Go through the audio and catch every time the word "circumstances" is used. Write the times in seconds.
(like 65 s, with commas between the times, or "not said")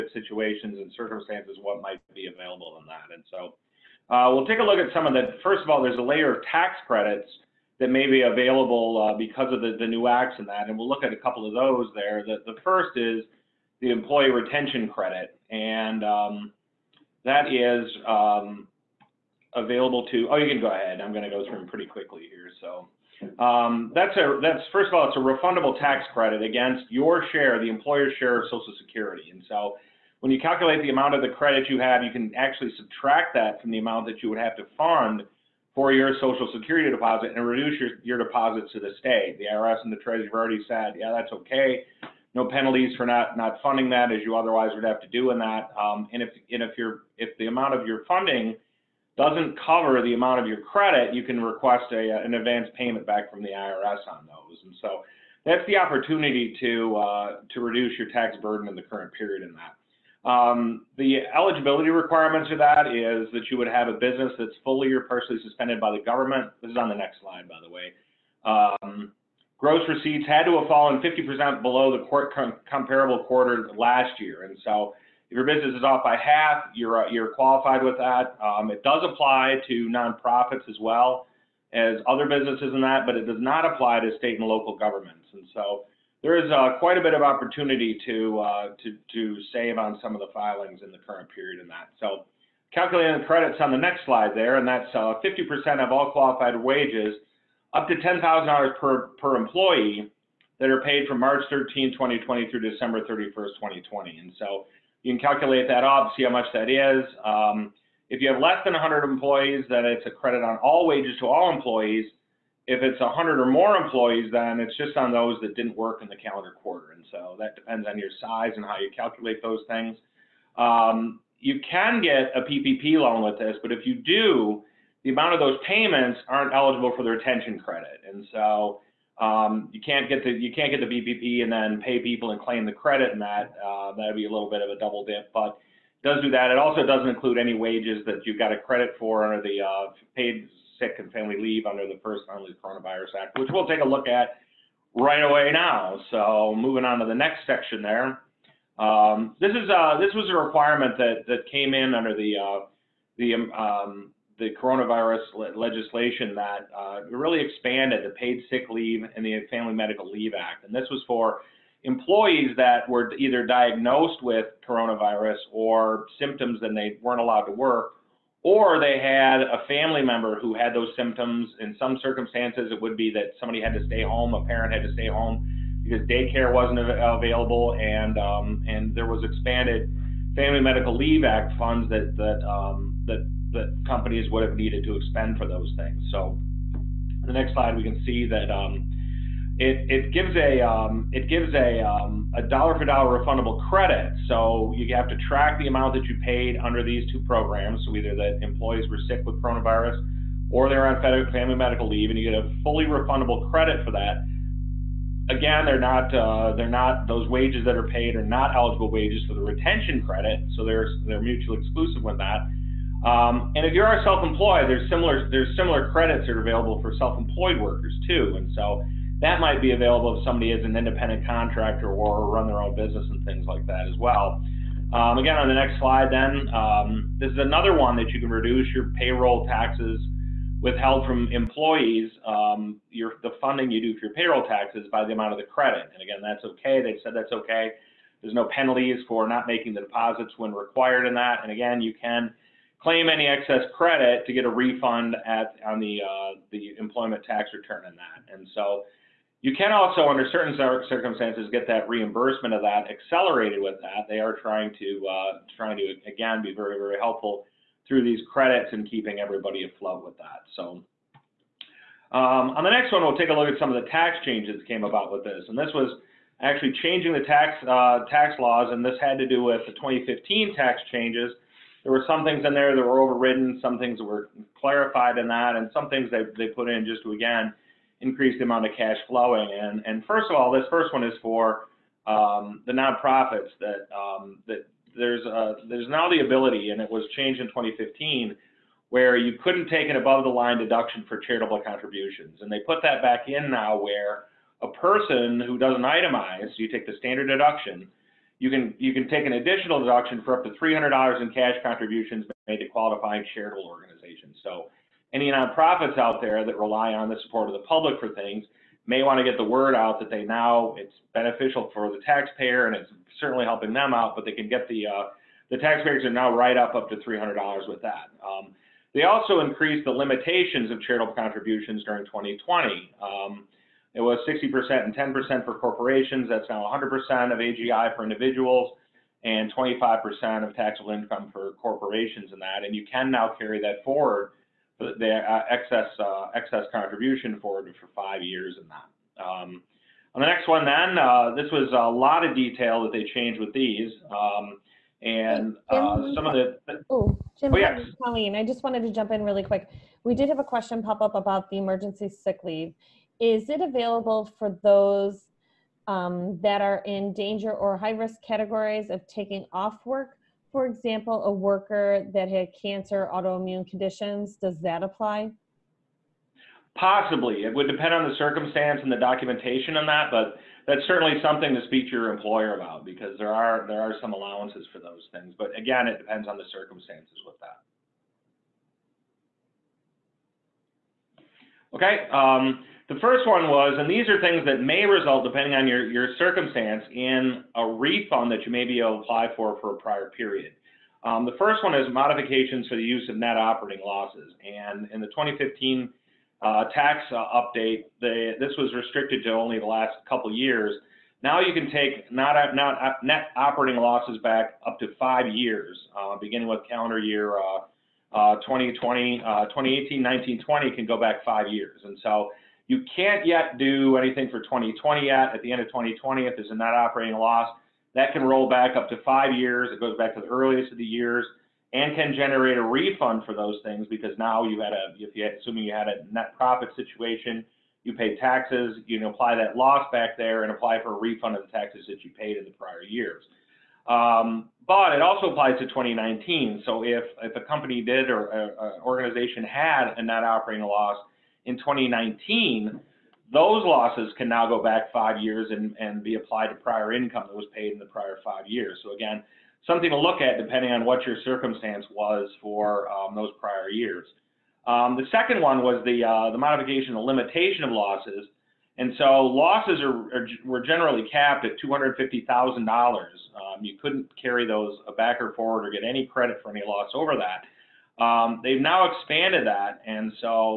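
0 s, 172 s, 250 s, 368 s, 376 s, 386 s, 451 s.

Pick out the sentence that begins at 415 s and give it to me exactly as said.
At the end of 2020, if there's a net operating loss, that can roll back up to five years.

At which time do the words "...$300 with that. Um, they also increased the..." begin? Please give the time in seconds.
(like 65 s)
316 s.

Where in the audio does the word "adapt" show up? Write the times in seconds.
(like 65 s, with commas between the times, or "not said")
not said.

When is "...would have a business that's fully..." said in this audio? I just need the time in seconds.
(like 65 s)
63 s.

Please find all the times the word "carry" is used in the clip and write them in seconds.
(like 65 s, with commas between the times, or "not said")
333 s, 464 s.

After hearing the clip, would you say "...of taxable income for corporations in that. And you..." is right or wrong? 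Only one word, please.
right.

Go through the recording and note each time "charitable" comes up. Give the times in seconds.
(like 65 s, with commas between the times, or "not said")
291 s, 303 s, 320 s.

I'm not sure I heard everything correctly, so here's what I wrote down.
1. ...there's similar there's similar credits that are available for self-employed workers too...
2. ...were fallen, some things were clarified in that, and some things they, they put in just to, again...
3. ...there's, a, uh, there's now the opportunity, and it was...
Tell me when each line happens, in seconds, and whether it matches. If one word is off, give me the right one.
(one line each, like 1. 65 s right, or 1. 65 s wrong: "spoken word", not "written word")
1. 214 s right
2. 272 s wrong: "overridden", not "fallen"
3. 284 s wrong: "ability", not "opportunity".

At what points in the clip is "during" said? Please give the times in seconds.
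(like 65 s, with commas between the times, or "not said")
321 s.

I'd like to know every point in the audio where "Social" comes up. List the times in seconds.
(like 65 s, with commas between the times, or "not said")
28 s, 36 s.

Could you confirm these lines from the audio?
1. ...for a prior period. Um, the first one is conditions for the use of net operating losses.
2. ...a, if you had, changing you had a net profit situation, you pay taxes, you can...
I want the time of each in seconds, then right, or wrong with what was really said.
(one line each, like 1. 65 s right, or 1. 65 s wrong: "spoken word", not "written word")
1. 389 s wrong: "modifications", not "conditions"
2. 424 s wrong: "assuming", not "changing".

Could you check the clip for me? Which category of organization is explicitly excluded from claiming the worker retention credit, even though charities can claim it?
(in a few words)
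state and local governments.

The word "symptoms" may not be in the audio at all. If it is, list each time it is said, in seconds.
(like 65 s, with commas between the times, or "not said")
166 s, 170 s.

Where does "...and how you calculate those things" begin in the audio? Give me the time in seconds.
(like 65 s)
118 s.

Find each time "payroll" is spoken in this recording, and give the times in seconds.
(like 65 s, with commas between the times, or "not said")
228 s, 234 s.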